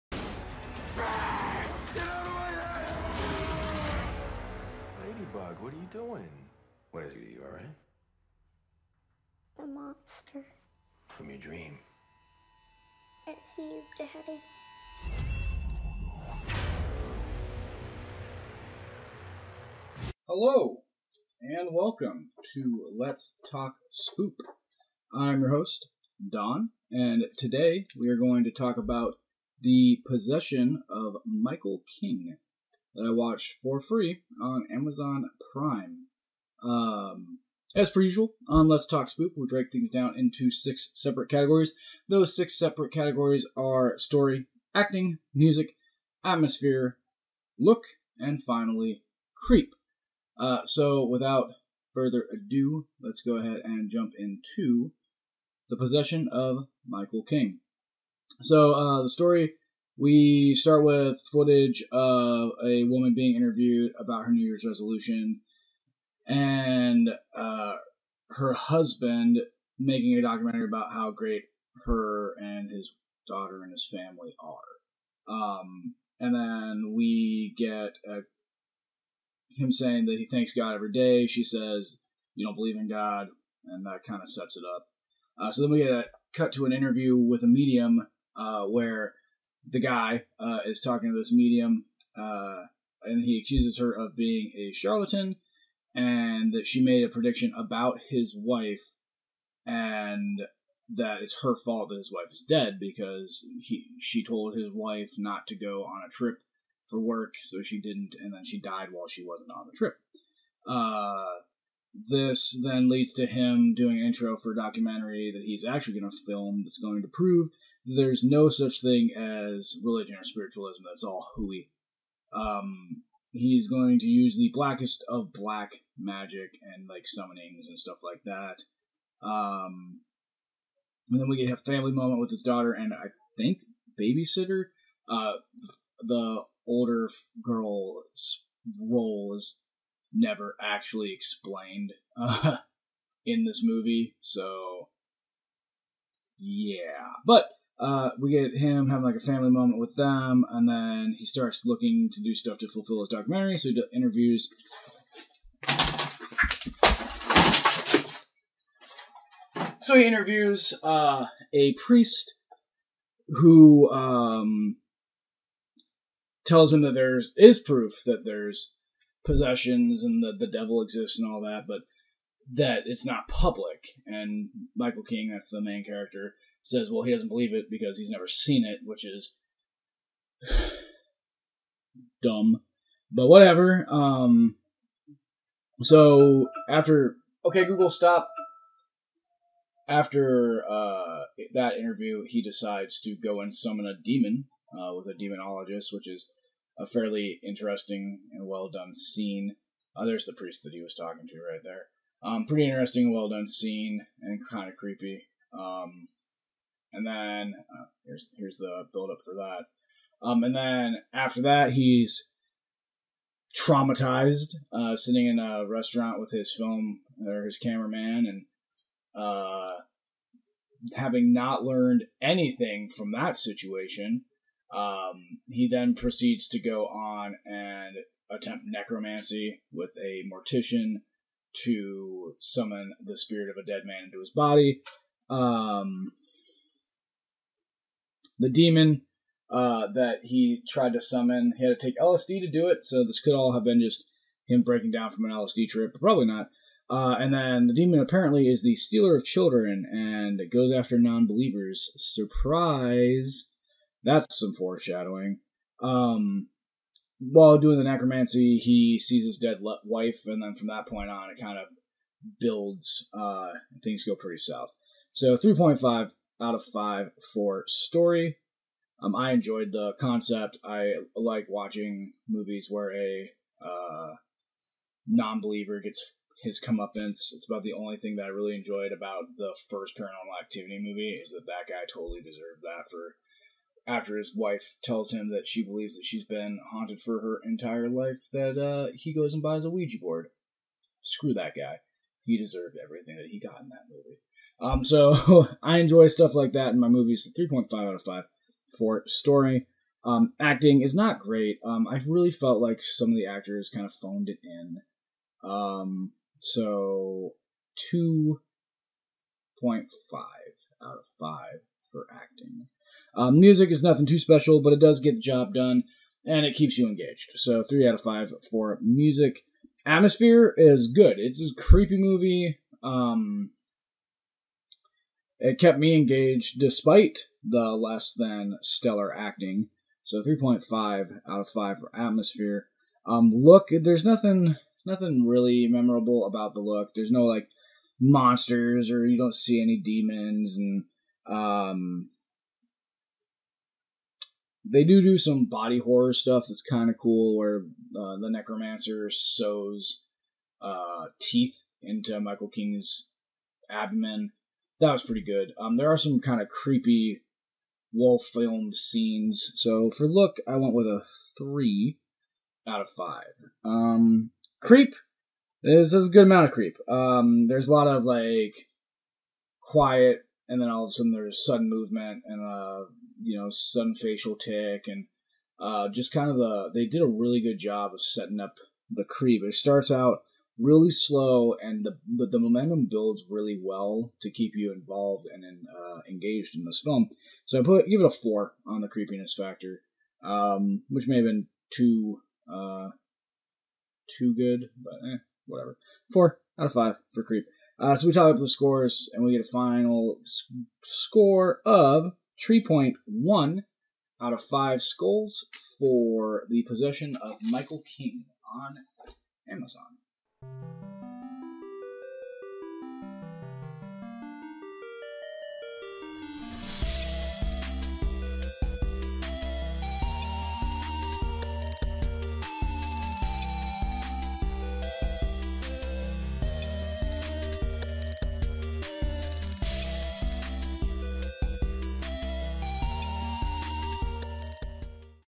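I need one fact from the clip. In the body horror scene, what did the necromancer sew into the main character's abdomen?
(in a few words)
teeth.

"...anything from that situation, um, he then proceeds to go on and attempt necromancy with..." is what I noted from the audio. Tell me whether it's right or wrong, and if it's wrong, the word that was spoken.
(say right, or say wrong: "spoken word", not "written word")
right.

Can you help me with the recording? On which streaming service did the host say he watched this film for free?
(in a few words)
Amazon Prime.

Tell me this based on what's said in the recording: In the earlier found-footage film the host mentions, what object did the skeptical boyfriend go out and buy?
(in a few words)
Ouija board.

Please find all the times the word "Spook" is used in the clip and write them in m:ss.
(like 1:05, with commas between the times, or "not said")
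0:23, 0:39.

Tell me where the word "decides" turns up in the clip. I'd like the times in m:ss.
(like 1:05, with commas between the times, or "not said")
3:12.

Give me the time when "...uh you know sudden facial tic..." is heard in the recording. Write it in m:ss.
6:12.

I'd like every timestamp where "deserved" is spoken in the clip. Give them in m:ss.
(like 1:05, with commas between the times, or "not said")
4:42, 4:52.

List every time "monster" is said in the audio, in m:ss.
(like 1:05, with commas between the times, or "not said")
0:09, 5:37.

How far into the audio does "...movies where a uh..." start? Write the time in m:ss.
4:32.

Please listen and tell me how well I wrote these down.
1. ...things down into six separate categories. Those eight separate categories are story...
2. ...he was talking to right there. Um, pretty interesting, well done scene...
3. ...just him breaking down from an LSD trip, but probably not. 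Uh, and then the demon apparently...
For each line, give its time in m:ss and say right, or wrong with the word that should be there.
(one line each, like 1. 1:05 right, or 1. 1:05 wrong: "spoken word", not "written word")
1. 0:39 wrong: "six", not "eight"
2. 3:20 right
3. 4:03 right.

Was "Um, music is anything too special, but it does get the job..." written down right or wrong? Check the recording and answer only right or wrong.
wrong.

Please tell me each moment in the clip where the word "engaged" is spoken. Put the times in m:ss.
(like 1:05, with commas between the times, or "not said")
5:16, 5:25, 6:26.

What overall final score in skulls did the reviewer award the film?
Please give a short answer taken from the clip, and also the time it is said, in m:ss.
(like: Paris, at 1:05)
3.1, at 6:42.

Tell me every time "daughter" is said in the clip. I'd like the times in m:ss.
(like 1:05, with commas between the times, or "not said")
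1:13, 2:12.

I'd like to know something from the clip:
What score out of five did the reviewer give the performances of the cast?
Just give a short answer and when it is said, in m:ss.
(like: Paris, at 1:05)
2.5, at 5:07.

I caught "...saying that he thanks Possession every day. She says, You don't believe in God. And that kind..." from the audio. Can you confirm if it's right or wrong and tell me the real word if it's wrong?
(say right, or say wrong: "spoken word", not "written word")
wrong: "God", not "Possession".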